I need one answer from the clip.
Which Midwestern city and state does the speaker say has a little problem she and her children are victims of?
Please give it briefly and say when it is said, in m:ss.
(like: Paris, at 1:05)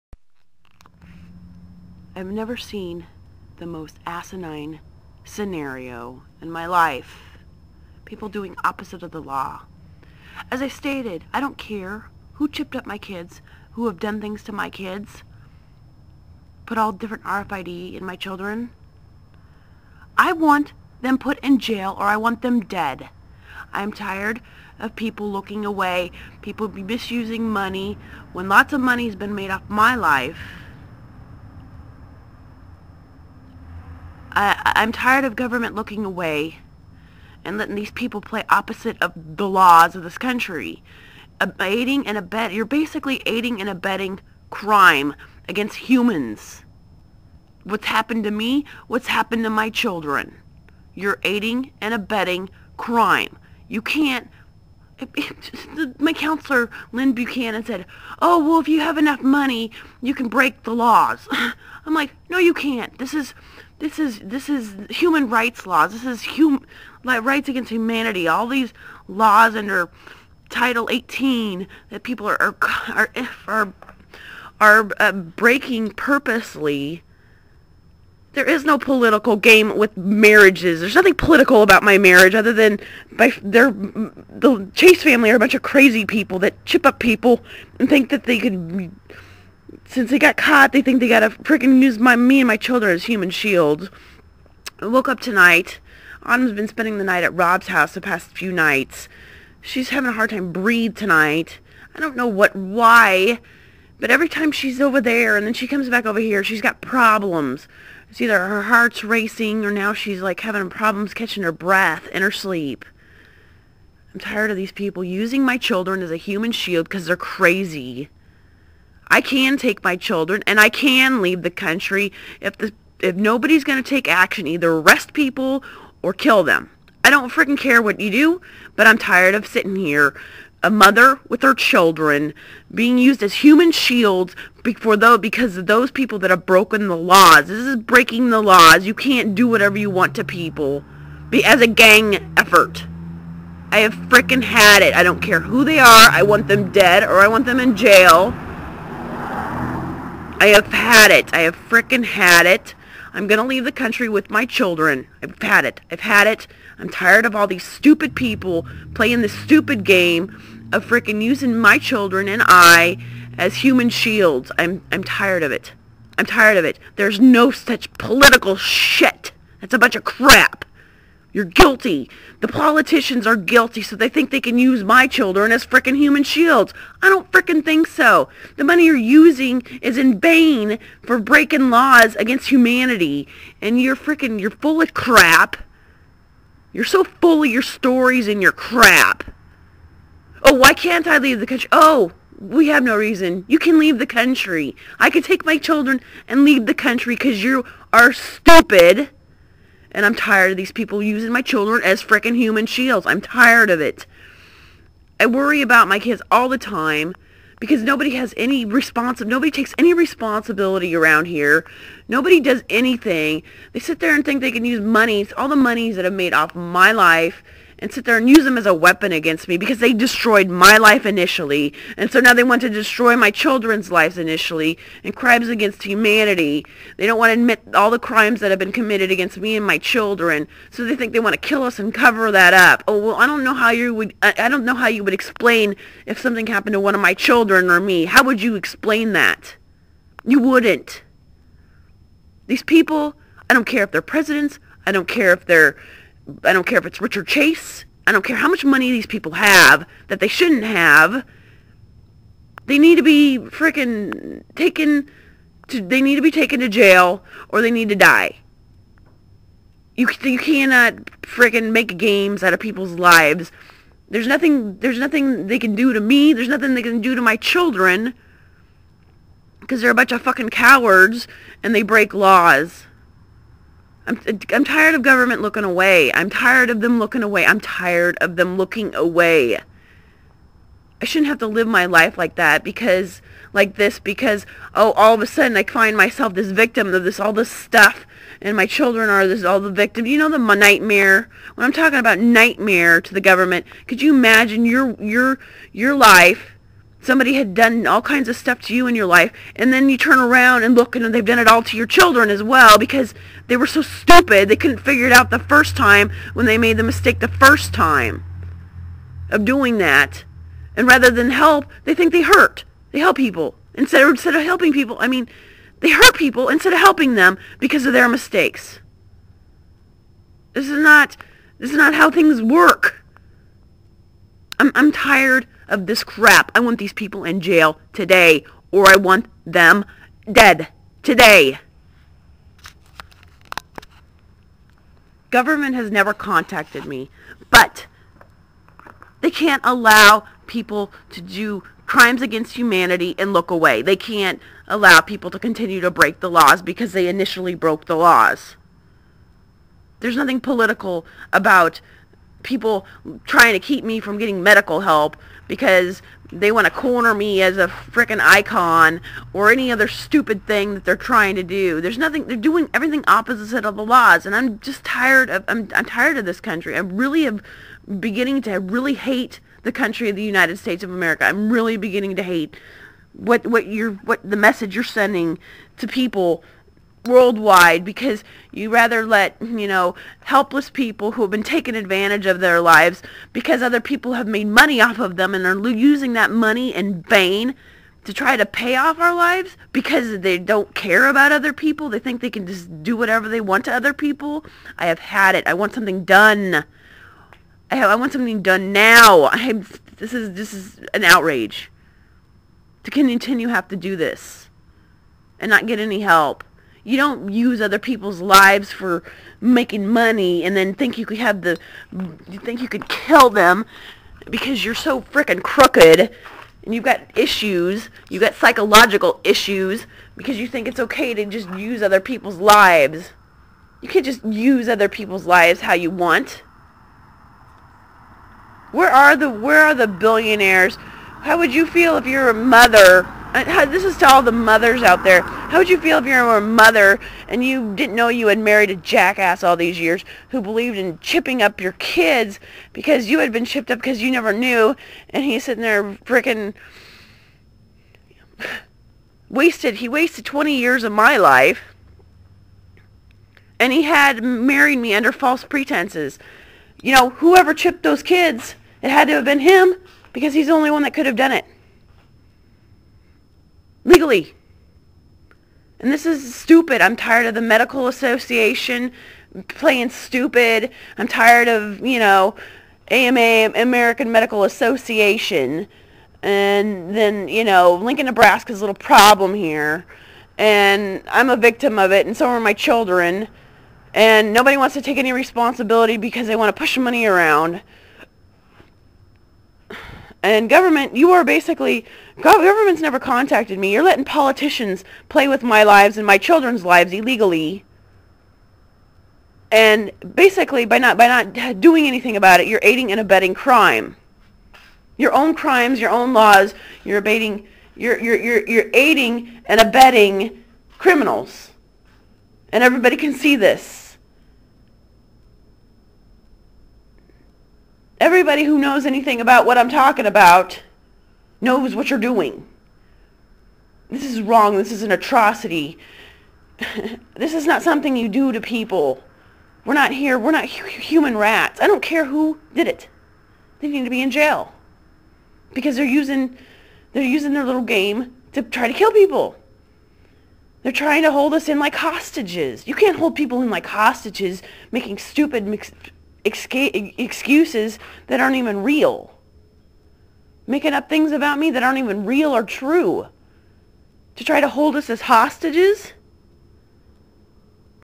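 Lincoln, Nebraska, at 7:57.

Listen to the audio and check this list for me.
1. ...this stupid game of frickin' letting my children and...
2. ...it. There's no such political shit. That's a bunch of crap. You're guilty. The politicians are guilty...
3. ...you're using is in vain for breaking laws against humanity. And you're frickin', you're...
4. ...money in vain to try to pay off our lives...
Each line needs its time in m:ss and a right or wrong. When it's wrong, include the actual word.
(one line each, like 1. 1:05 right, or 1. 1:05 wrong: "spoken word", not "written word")
1. 2:39 wrong: "using", not "letting"
2. 2:46 right
3. 2:58 right
4. 6:26 right.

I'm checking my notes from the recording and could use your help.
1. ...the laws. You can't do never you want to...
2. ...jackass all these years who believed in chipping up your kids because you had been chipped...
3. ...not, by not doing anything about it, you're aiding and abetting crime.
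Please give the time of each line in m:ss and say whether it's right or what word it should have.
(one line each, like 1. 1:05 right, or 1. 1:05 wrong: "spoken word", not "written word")
1. 2:18 wrong: "whatever", not "never"
2. 7:18 right
3. 8:20 right.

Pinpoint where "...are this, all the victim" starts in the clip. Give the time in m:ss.
4:49.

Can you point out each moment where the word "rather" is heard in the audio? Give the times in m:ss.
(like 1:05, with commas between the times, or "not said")
5:10, 6:18.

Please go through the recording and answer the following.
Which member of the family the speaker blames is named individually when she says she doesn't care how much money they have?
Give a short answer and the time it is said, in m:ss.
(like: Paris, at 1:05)
Richard Chase, at 4:07.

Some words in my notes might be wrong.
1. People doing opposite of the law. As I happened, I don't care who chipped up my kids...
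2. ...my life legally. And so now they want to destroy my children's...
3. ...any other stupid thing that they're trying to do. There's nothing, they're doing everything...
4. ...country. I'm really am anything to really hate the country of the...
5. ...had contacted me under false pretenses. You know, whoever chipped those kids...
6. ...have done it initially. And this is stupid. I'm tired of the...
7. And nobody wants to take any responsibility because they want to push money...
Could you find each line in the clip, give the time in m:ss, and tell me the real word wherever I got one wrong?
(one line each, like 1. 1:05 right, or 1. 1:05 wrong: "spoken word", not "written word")
1. 0:08 wrong: "stated", not "happened"
2. 3:40 wrong: "initially", not "legally"
3. 5:59 right
4. 6:06 wrong: "beginning", not "anything"
5. 7:33 wrong: "married", not "contacted"
6. 7:41 wrong: "legally", not "initially"
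7. 8:03 right.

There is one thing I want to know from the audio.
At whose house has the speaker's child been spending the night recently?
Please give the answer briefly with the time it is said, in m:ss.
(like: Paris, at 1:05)
Rob's, at 1:37.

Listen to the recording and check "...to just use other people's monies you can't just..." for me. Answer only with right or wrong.
wrong.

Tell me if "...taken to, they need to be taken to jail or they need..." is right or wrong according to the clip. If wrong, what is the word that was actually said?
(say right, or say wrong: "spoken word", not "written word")
right.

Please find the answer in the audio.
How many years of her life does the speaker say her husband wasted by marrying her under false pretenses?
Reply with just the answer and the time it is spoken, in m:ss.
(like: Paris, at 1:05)
20, at 7:30.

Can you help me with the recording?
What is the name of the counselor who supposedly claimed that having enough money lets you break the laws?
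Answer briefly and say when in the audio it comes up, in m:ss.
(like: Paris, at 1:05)
Lynn Buchanan, at 0:56.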